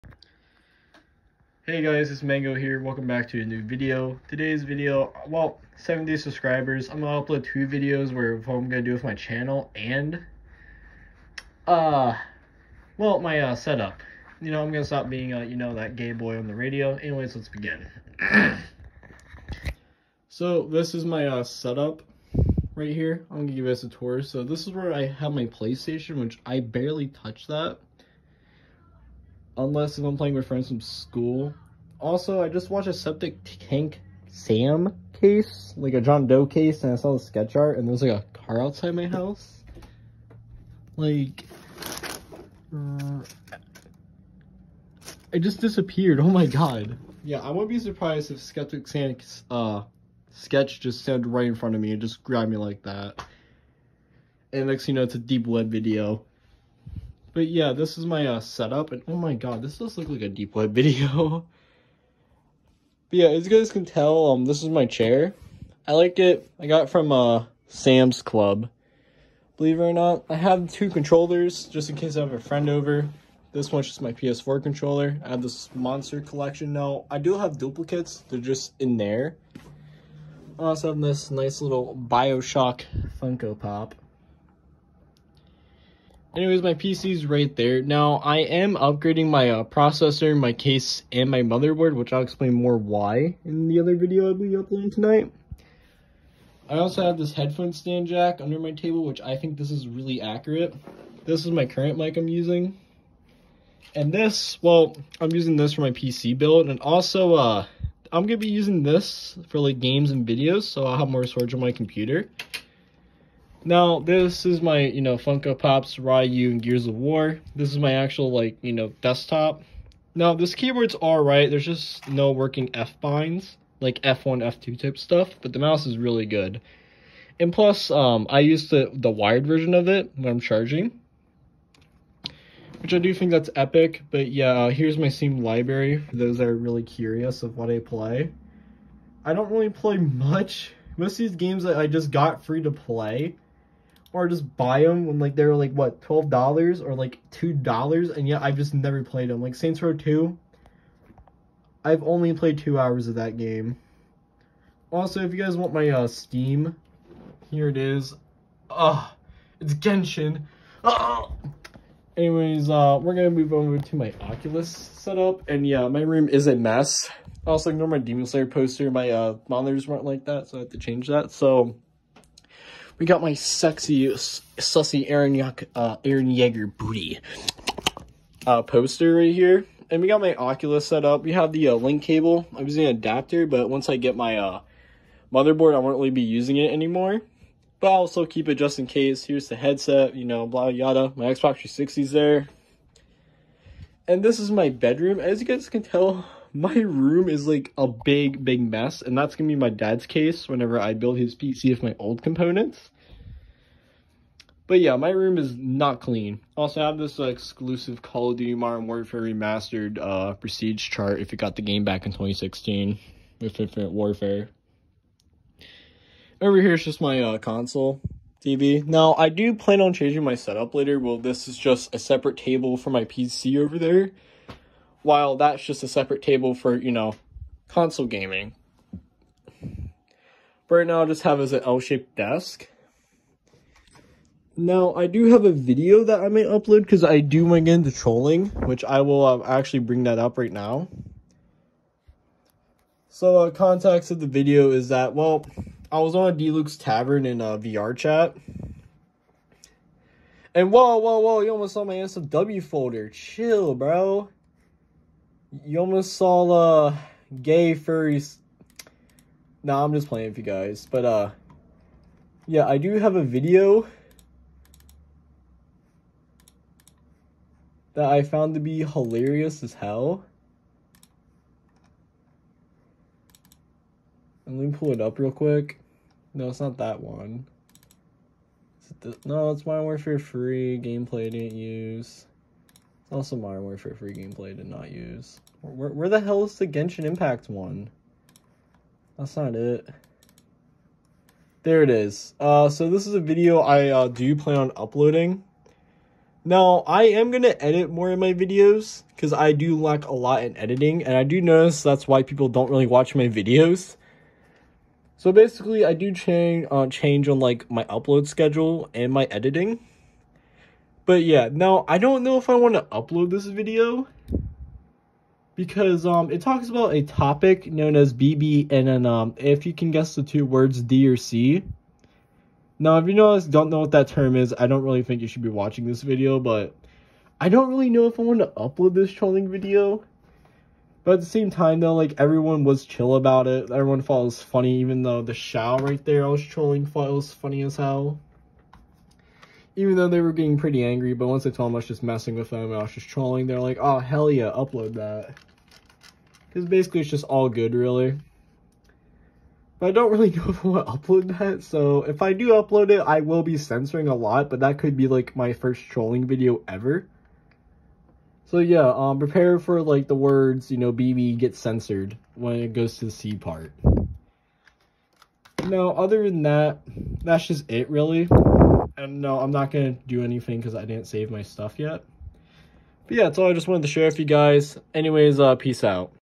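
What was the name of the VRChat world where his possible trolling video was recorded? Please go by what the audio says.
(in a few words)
Deluxe Tavern.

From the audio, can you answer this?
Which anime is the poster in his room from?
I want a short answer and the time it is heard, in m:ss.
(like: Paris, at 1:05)
Demon Slayer, at 2:47.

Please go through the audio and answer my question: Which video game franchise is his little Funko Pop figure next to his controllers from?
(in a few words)
Bioshock.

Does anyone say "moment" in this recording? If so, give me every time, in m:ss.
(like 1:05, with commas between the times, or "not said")
not said.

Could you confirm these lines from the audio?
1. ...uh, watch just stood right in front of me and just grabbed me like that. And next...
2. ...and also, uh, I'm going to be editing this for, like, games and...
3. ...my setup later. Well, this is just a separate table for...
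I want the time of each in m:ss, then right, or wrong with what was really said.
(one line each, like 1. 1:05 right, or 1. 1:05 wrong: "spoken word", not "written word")
1. 0:49 wrong: "sketch", not "watch"
2. 1:46 wrong: "using", not "editing"
3. 3:40 right.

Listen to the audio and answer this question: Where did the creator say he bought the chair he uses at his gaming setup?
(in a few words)
Sam's Club.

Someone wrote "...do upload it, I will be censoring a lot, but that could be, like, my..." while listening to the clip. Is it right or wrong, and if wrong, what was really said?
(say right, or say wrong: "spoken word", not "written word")
right.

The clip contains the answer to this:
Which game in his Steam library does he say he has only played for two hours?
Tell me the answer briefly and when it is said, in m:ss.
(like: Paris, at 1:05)
Saints Row Two, at 2:29.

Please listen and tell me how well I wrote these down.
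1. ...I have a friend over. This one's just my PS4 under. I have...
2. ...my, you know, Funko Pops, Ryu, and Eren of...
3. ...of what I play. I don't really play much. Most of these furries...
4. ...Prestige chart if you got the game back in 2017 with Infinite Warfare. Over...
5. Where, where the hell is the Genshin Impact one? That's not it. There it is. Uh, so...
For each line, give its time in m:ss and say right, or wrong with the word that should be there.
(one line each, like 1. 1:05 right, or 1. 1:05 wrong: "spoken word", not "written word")
1. 1:12 wrong: "controller", not "under"
2. 1:54 wrong: "Gears", not "Eren"
3. 2:17 wrong: "games", not "furries"
4. 3:30 wrong: "2016", not "2017"
5. 4:45 right.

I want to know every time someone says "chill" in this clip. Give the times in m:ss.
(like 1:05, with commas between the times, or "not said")
4:13, 5:32.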